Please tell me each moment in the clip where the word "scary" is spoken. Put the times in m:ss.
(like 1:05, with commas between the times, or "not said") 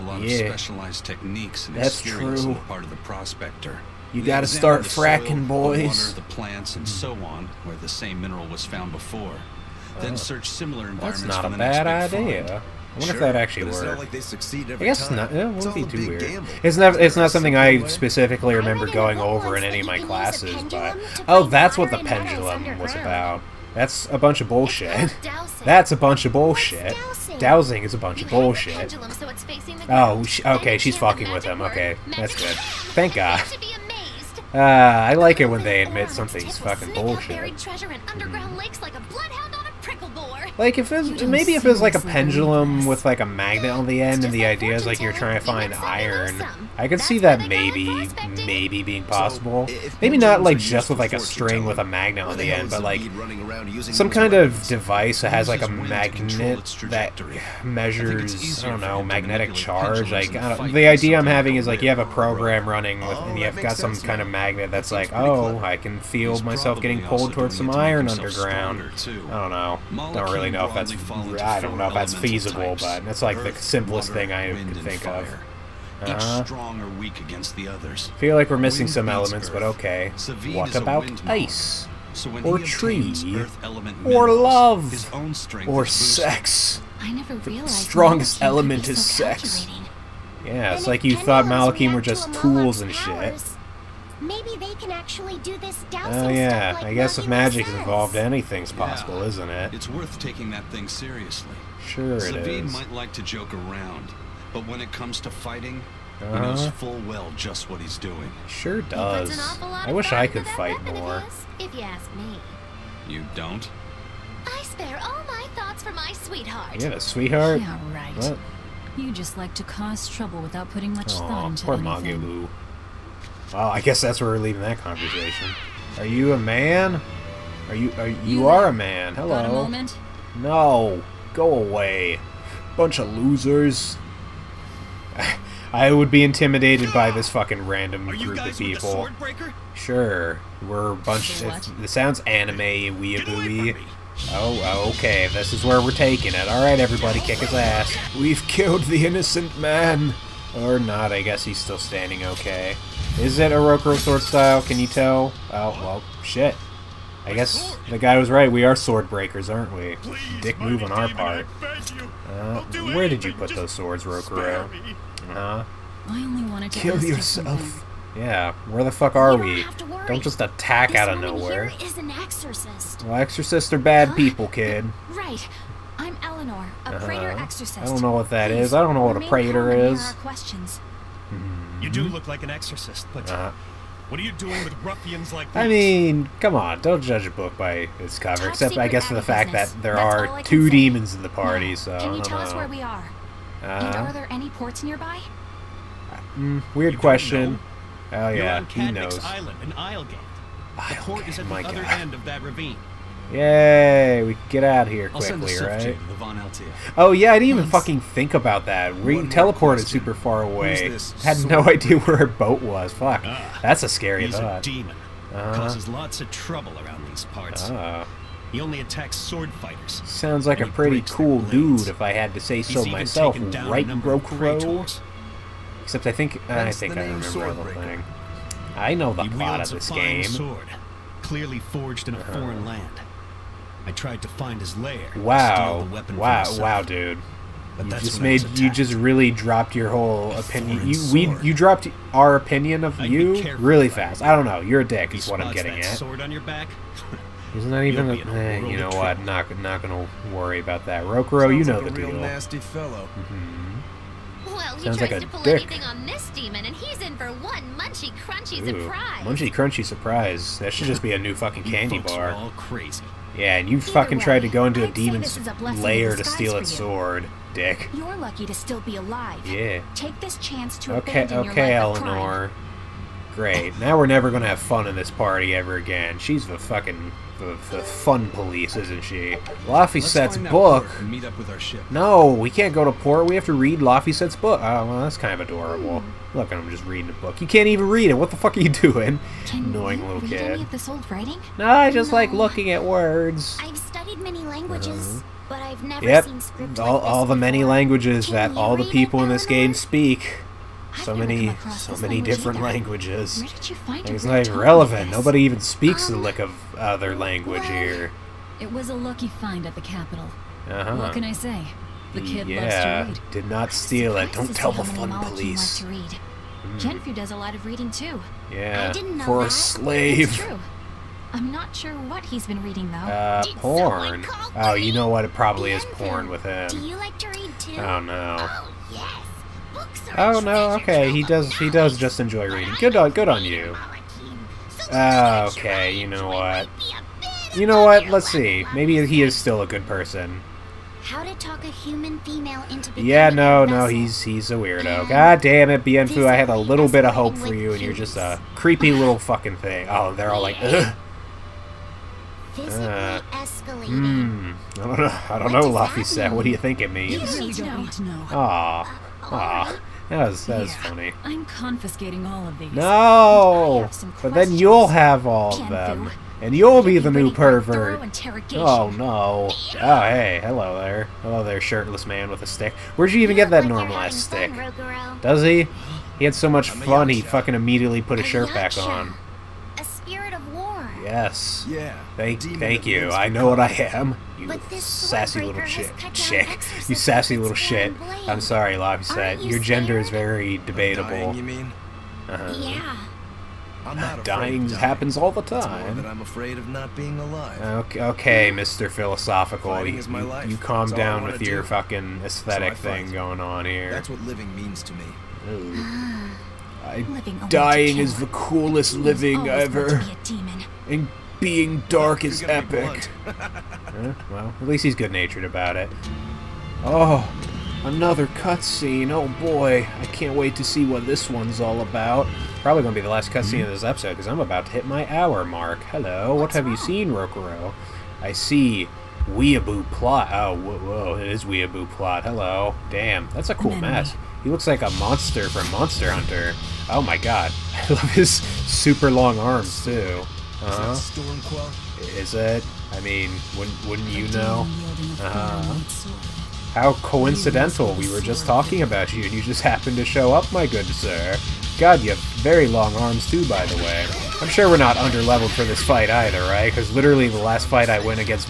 3:33.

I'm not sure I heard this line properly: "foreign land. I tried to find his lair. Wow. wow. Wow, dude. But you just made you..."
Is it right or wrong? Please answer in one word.
right.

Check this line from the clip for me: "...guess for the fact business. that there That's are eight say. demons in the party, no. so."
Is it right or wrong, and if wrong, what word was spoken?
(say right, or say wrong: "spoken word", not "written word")
wrong: "two", not "eight".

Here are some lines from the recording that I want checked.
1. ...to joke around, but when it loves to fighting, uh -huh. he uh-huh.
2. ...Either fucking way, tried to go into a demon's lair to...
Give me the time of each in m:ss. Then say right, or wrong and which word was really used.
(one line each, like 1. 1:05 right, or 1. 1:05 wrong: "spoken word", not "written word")
1. 1:43 wrong: "comes", not "loves"
2. 4:23 right.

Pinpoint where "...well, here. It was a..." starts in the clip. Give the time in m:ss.
5:07.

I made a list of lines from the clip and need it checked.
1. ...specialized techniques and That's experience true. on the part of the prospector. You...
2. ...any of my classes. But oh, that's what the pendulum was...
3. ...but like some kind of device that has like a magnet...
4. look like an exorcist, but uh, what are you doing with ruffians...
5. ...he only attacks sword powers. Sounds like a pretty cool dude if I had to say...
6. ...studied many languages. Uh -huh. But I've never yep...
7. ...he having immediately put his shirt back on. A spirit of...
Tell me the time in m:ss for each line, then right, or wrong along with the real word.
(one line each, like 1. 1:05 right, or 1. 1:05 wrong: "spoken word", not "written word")
1. 0:00 right
2. 0:19 right
3. 0:52 right
4. 3:02 right
5. 3:38 wrong: "fighters", not "powers"
6. 4:53 right
7. 6:17 wrong: "fucking", not "having".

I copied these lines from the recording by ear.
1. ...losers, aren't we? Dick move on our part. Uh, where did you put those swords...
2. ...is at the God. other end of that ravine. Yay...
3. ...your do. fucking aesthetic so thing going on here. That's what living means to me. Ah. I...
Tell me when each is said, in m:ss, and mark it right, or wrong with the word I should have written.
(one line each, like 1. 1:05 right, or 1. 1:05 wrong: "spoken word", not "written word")
1. 2:39 wrong: "breakers", not "losers"
2. 3:21 right
3. 6:41 right.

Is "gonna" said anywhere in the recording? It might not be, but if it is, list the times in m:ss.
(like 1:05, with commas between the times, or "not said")
4:09, 4:34.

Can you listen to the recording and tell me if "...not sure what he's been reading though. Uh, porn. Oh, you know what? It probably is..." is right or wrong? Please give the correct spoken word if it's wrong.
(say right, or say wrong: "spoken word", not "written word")
right.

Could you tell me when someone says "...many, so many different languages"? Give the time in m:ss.
5:01.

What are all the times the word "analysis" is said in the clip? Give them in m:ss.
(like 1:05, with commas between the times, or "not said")
not said.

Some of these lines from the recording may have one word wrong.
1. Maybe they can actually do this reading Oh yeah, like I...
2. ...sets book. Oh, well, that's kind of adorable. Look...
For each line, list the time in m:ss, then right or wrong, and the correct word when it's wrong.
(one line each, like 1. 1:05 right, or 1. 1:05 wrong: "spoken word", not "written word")
1. 1:34 wrong: "dowsing", not "reading"
2. 4:44 right.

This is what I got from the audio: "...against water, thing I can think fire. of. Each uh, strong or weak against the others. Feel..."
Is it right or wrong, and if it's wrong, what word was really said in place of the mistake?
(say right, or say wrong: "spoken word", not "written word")
wrong: "simplest", not "against".